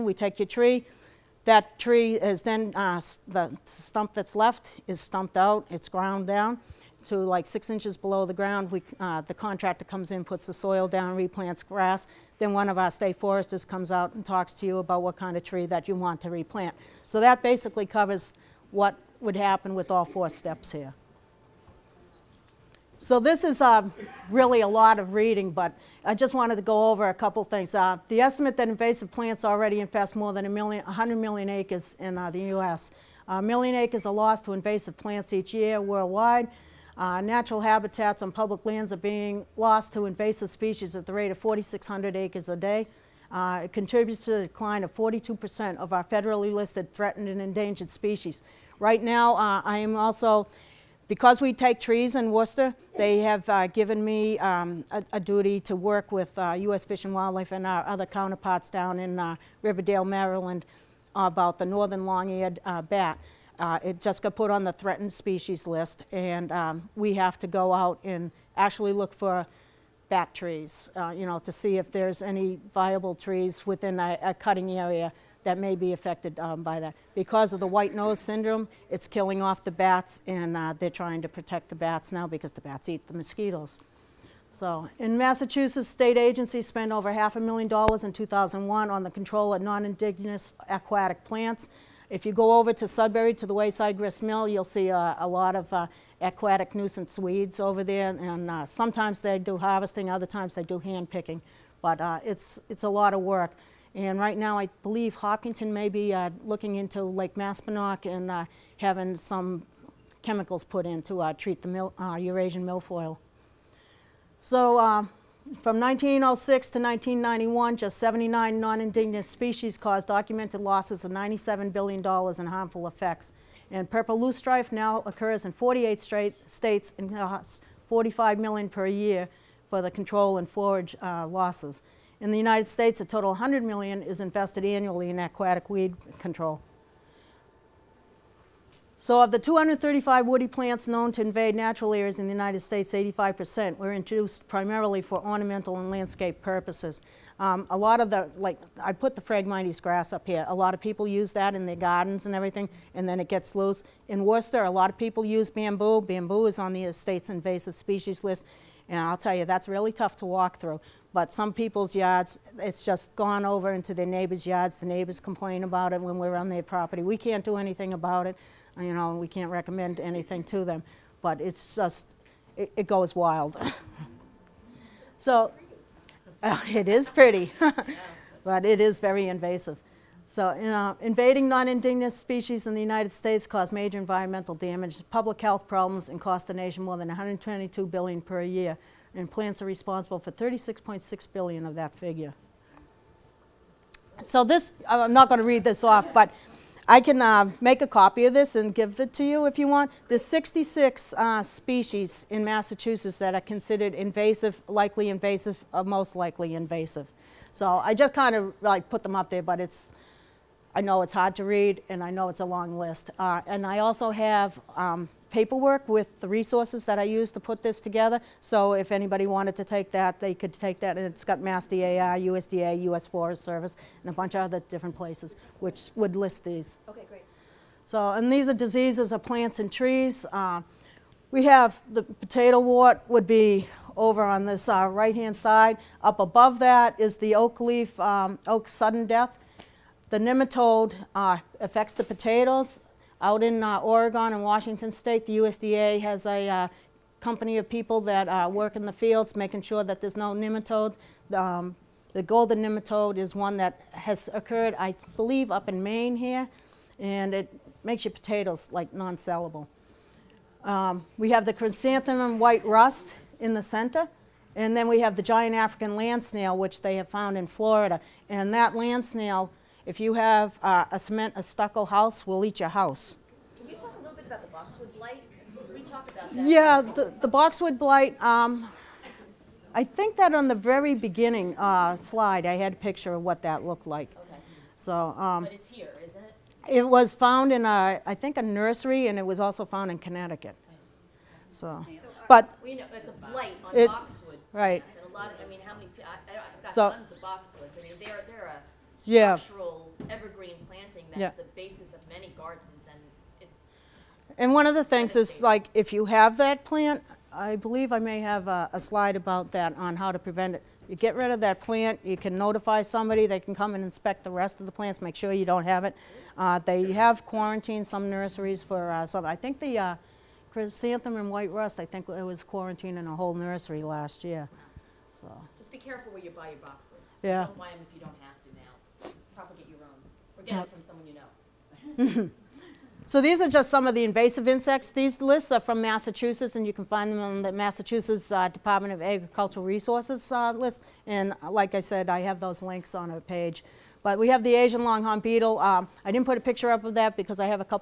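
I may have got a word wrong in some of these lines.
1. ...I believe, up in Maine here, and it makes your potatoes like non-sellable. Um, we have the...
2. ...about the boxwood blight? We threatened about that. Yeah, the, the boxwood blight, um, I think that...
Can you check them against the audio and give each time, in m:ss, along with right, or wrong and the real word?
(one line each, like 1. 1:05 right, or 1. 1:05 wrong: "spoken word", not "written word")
1. 4:14 right
2. 4:34 wrong: "talked", not "threatened".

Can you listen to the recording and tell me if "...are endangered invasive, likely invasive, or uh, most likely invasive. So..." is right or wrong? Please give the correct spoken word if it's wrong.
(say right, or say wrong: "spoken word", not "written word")
wrong: "considered", not "endangered".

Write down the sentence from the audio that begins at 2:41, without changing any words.
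But some people's yards, it's just gone over into their neighbors' yards.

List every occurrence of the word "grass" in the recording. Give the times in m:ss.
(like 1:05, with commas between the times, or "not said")
0:11, 2:29.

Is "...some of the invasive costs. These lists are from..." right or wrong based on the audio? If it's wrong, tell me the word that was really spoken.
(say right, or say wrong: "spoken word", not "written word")
wrong: "insects", not "costs".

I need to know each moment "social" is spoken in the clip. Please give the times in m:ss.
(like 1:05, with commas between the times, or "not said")
not said.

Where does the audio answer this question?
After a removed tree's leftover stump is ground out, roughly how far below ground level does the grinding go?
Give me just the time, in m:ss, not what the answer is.
0:07.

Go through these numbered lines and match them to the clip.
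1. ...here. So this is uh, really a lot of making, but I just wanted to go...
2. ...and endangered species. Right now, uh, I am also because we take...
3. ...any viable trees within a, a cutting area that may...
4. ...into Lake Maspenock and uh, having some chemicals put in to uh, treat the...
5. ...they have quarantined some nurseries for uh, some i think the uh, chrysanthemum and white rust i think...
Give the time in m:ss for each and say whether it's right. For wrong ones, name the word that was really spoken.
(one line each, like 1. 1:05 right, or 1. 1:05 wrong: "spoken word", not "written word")
1. 0:20 wrong: "reading", not "making"
2. 0:47 right
3. 1:12 right
4. 1:46 right
5. 5:16 right.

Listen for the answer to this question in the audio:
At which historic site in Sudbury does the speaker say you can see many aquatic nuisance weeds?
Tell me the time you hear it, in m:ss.
1:33.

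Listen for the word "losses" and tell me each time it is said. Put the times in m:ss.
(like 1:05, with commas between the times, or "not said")
2:00, 2:11.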